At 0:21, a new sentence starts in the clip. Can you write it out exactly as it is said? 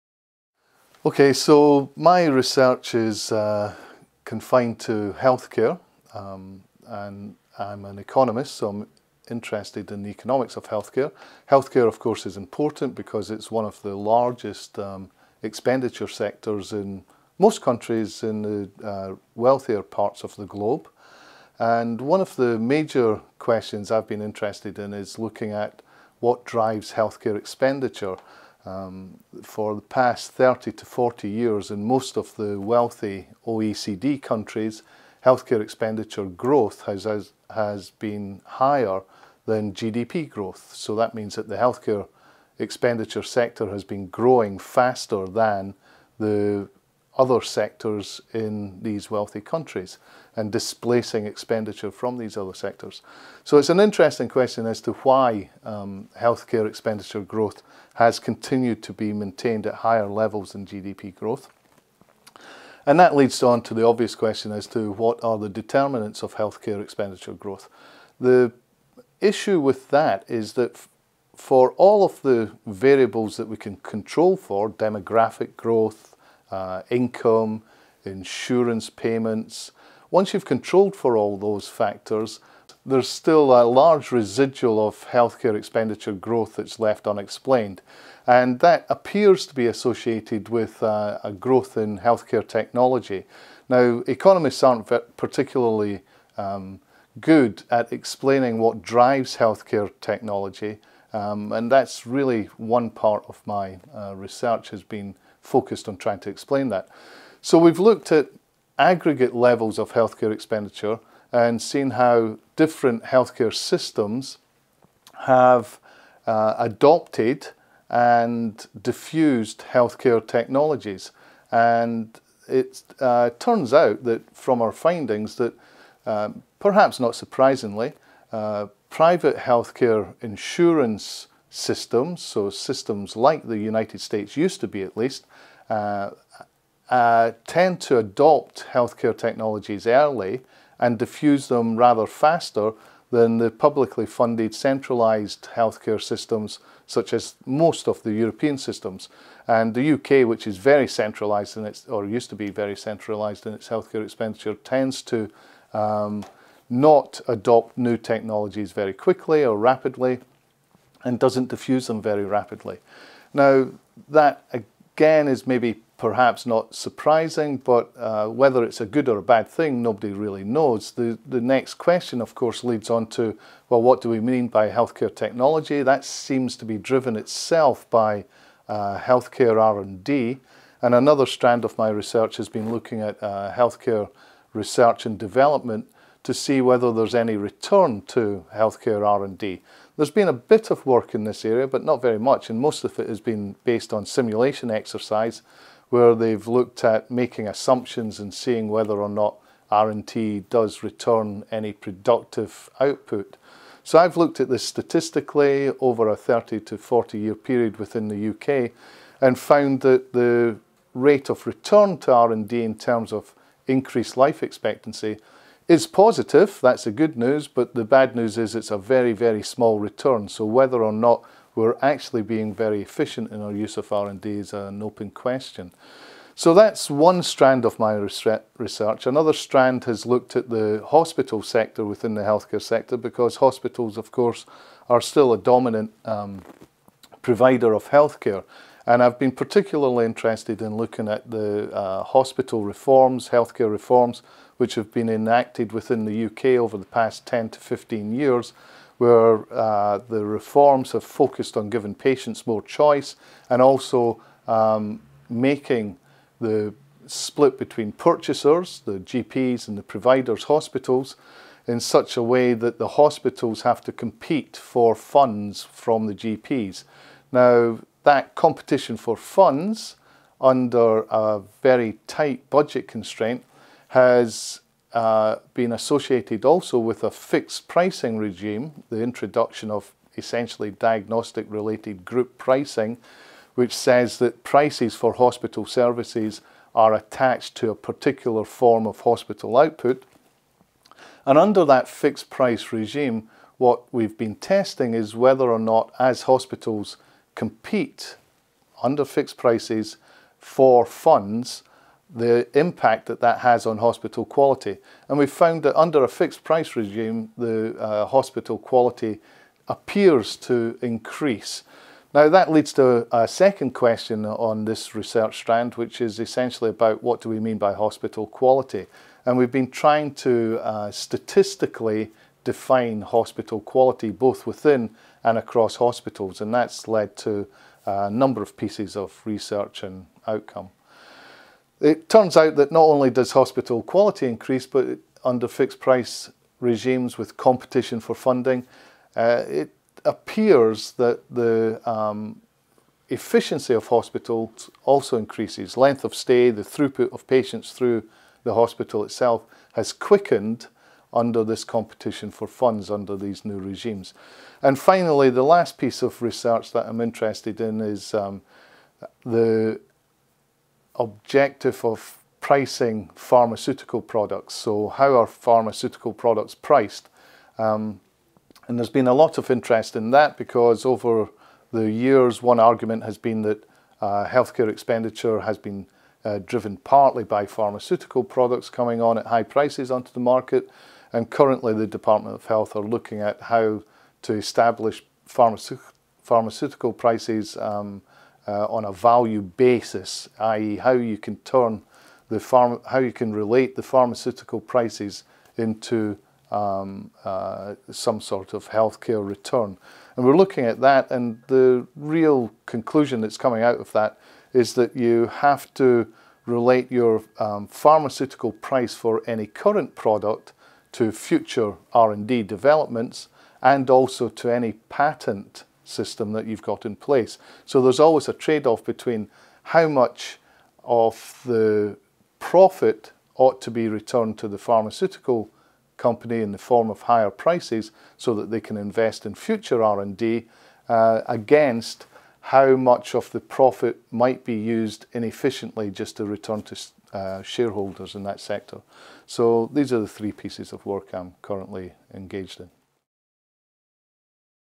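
And one of the major questions I've been interested in is looking at what drives healthcare expenditure.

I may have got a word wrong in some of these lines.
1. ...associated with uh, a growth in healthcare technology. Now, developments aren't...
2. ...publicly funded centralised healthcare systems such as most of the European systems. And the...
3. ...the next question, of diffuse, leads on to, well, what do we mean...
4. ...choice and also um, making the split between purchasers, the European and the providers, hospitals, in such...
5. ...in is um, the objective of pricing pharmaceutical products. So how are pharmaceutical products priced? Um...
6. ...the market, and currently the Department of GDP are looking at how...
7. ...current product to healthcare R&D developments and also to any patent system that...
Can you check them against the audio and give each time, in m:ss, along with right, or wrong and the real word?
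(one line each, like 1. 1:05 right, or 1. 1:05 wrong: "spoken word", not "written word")
1. 1:29 wrong: "economists", not "developments"
2. 2:23 right
3. 2:51 wrong: "course", not "diffuse"
4. 4:12 wrong: "GPs", not "European"
5. 5:57 right
6. 6:20 wrong: "Health", not "GDP"
7. 6:49 wrong: "future", not "healthcare".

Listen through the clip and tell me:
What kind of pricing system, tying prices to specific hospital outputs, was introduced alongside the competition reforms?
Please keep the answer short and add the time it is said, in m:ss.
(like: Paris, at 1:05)
diagnostic related group pricing, at 4:40.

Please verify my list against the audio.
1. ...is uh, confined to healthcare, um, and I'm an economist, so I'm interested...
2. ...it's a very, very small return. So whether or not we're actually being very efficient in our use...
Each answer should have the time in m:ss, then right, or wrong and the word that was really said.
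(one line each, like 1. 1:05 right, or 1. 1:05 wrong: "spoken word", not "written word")
1. 0:02 right
2. 3:38 right.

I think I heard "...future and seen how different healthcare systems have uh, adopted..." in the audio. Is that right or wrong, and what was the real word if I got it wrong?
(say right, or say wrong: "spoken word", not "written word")
wrong: "expenditure", not "future".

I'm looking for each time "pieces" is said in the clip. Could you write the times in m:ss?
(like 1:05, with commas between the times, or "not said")
5:28, 5:55, 7:20.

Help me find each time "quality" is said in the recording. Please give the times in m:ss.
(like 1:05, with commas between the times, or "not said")
5:04, 5:08, 5:18, 5:23, 5:33.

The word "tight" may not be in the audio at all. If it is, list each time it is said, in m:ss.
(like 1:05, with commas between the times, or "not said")
4:32.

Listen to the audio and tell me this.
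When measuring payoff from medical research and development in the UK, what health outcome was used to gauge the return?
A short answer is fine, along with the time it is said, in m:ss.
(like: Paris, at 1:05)
life expectancy, at 3:34.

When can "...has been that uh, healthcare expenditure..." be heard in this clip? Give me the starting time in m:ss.
6:13.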